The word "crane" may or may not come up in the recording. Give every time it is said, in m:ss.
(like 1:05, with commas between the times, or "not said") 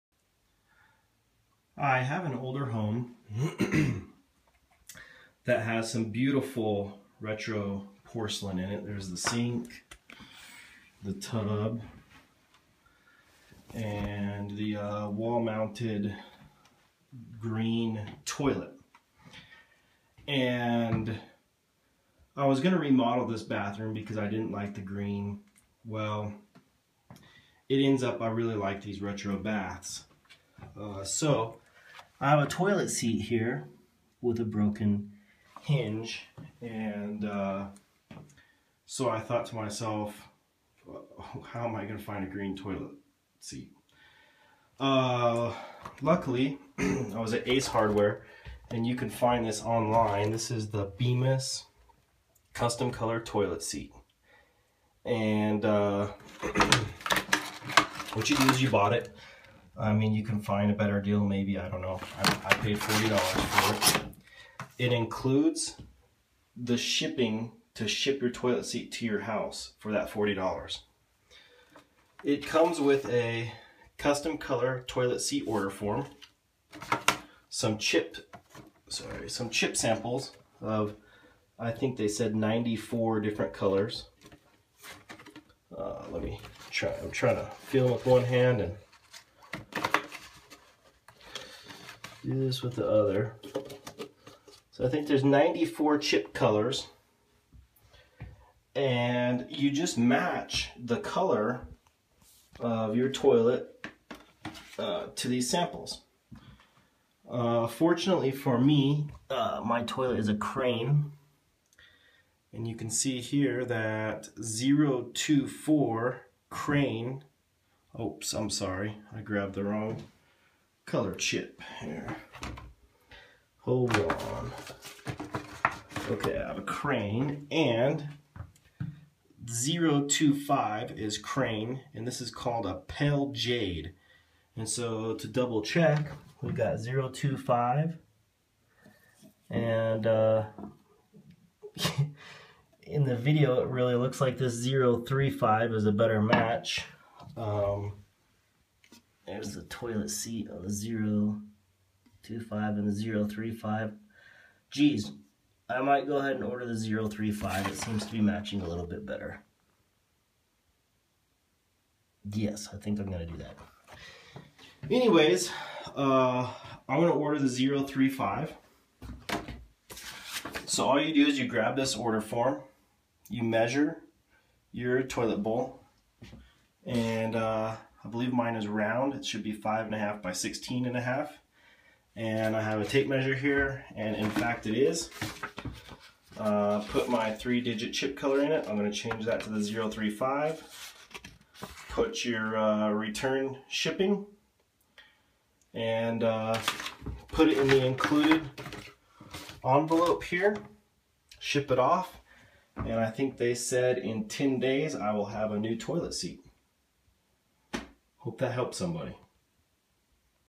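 1:50, 1:56, 2:06, 2:11.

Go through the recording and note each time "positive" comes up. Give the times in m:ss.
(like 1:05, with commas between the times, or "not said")
not said.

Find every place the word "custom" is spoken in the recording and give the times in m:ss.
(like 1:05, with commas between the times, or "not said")
0:52, 1:13.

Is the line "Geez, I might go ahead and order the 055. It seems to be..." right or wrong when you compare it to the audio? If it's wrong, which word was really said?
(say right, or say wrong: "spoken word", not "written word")
wrong: "035", not "055".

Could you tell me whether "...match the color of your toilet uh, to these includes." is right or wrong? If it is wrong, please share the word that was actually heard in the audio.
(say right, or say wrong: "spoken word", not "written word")
wrong: "samples", not "includes".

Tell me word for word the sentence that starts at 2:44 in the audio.
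Anyways, uh, I'm going to order the 035.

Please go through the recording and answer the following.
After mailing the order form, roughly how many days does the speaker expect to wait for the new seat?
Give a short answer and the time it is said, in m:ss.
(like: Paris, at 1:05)
10, at 3:24.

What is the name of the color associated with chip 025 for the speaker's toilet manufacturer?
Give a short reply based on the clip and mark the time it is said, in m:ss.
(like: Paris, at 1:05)
pale jade, at 2:12.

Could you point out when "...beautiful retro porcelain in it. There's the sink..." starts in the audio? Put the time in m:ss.
0:06.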